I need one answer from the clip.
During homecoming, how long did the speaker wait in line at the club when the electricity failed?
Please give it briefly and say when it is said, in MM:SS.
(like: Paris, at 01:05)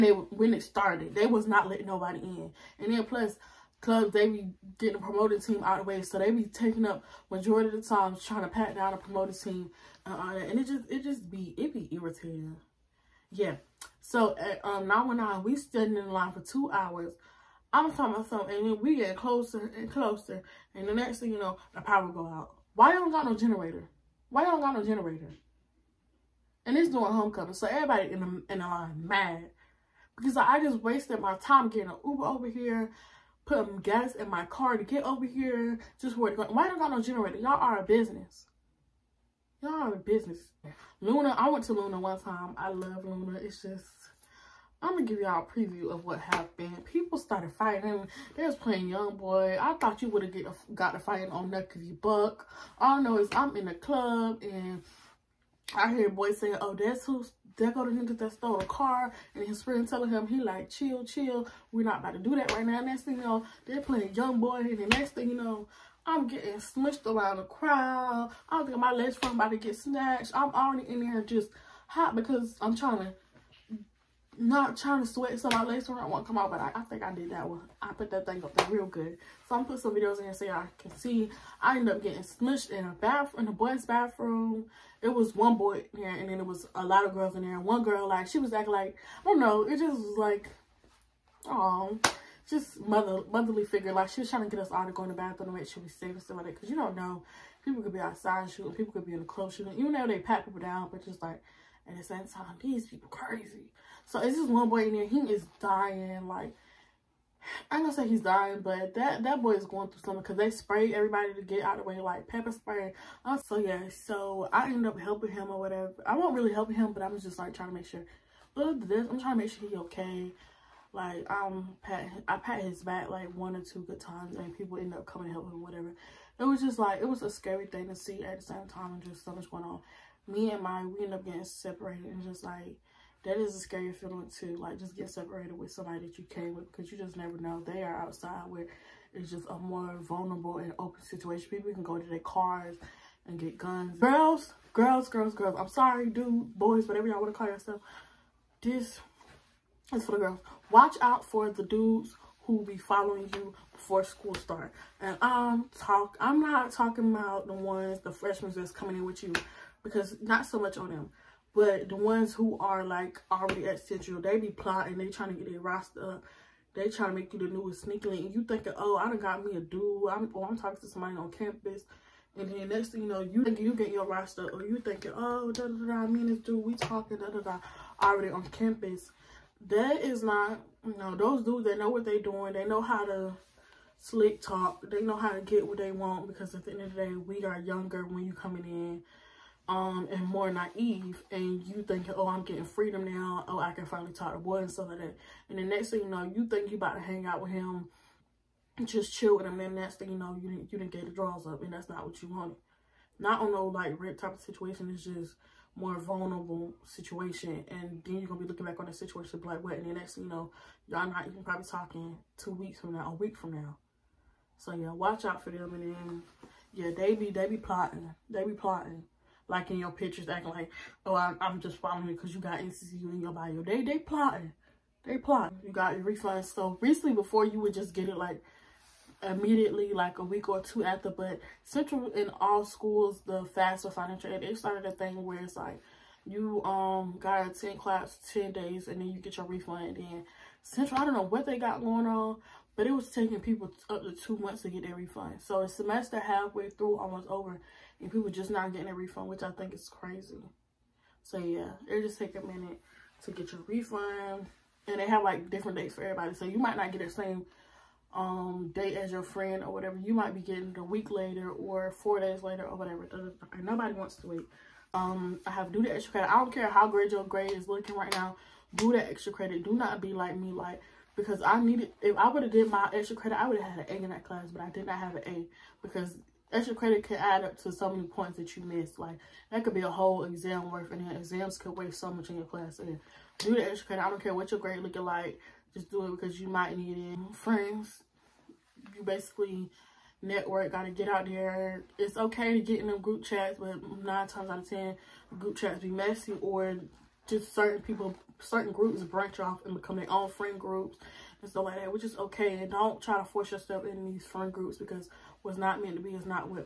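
2 hours, at 00:16.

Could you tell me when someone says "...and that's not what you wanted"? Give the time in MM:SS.
03:21.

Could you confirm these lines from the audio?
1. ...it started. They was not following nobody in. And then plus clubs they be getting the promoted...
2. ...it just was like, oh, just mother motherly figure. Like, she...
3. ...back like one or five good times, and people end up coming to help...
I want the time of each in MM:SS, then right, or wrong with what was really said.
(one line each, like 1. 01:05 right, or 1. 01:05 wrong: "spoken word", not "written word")
1. 00:00 wrong: "letting", not "following"
2. 01:29 right
3. 02:02 wrong: "two", not "five".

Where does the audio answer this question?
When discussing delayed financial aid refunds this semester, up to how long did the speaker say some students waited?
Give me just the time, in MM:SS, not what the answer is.
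04:04.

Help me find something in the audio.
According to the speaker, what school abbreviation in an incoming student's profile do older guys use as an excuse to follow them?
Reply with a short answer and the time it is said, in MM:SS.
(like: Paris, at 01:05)
NCCU, at 03:42.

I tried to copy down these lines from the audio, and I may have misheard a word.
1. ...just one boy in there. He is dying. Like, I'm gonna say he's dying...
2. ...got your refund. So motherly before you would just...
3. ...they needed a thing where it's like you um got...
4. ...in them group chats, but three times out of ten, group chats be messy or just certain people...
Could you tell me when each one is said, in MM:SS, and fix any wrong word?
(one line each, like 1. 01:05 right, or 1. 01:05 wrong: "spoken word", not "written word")
1. 01:44 right
2. 03:45 wrong: "recently", not "motherly"
3. 03:54 wrong: "started", not "needed"
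4. 04:52 wrong: "nine", not "three".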